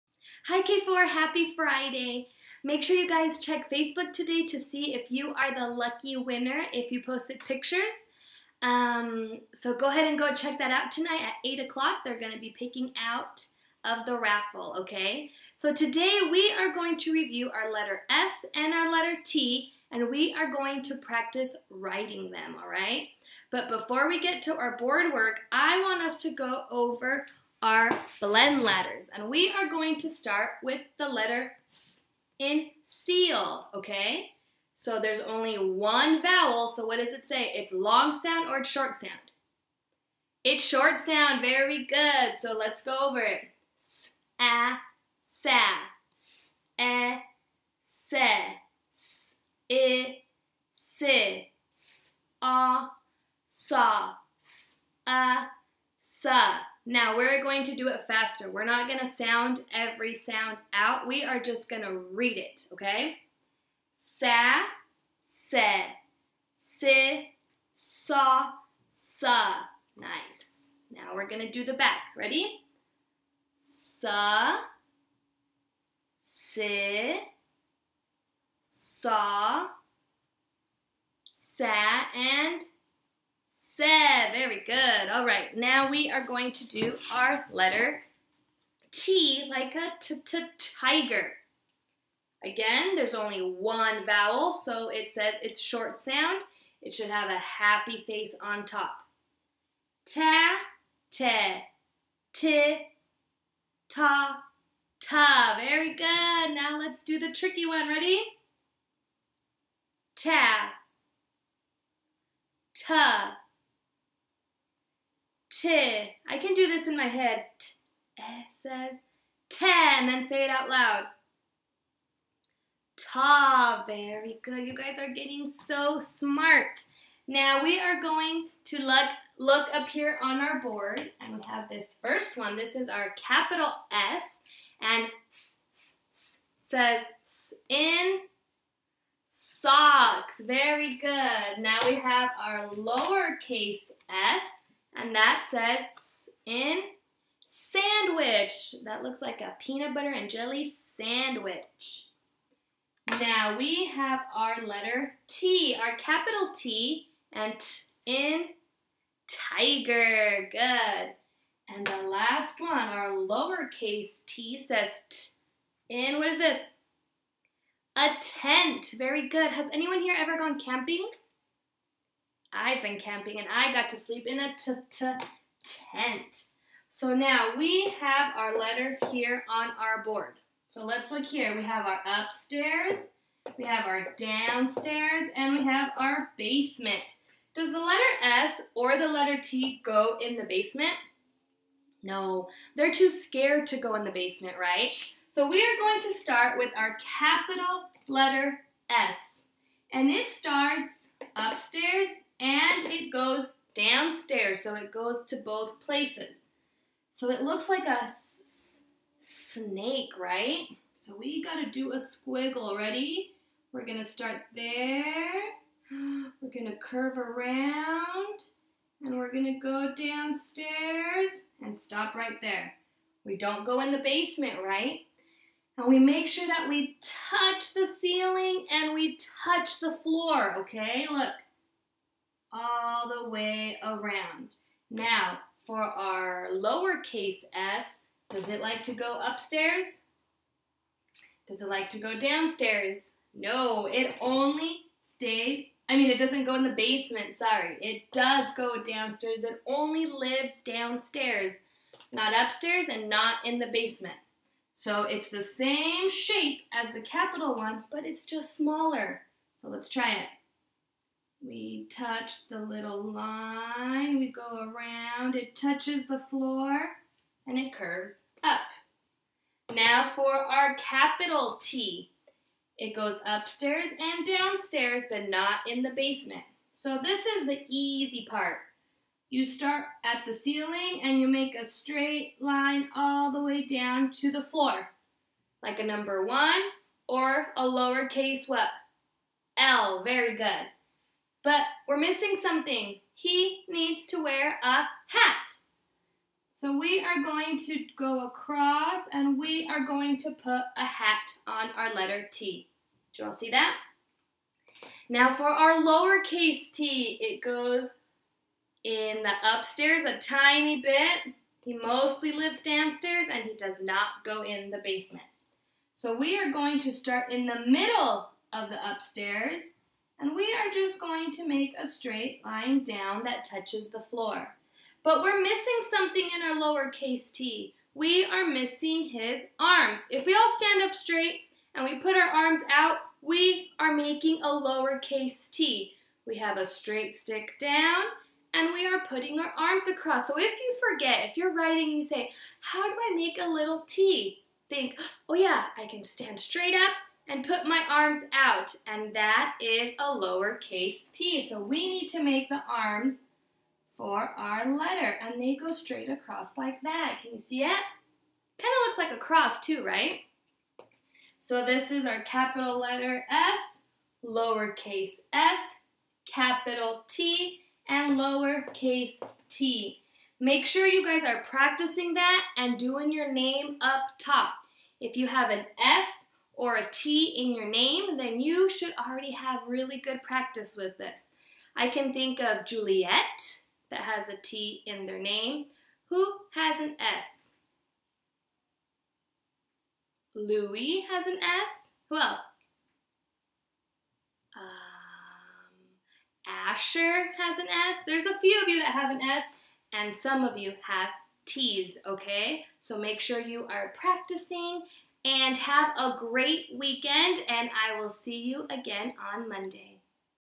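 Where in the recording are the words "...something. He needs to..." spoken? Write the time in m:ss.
4:52.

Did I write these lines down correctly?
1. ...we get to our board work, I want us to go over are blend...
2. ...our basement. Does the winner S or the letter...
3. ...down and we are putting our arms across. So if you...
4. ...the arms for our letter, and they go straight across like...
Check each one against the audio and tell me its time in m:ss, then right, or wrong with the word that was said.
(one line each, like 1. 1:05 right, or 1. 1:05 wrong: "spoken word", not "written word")
1. 0:24 right
2. 3:05 wrong: "letter", not "winner"
3. 5:37 right
4. 5:52 right.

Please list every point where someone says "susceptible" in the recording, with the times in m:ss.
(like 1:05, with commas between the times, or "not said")
not said.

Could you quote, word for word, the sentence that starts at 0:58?
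We're not going to sound every sound out.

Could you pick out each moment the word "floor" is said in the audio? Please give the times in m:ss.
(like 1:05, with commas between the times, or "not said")
3:50, 4:26, 4:44, 5:24.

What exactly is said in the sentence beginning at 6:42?
So make sure you are practicing and have a great weekend, and I will see you again on Monday.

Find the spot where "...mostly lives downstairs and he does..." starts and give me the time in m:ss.
5:11.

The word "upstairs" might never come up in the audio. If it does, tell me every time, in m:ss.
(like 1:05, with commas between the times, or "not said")
3:02, 3:21, 3:59, 4:12, 4:33, 5:09, 5:18.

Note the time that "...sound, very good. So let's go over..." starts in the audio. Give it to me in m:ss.
0:41.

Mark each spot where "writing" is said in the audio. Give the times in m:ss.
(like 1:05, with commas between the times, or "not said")
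0:21, 5:41.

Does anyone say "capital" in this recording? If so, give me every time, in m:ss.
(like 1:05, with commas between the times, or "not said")
2:13, 2:35, 3:17, 4:17, 4:30, 6:02, 6:06.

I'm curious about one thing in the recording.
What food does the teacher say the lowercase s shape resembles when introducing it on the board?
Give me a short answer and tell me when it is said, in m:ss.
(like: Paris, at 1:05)
peanut butter and jelly sandwich, at 2:29.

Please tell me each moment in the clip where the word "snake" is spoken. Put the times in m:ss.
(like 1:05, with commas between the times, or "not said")
3:29.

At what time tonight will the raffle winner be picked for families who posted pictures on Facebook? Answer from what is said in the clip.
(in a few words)
8 o'clock.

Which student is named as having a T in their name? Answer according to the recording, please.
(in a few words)
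Juliet.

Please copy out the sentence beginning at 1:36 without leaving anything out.
It should have a happy face on top.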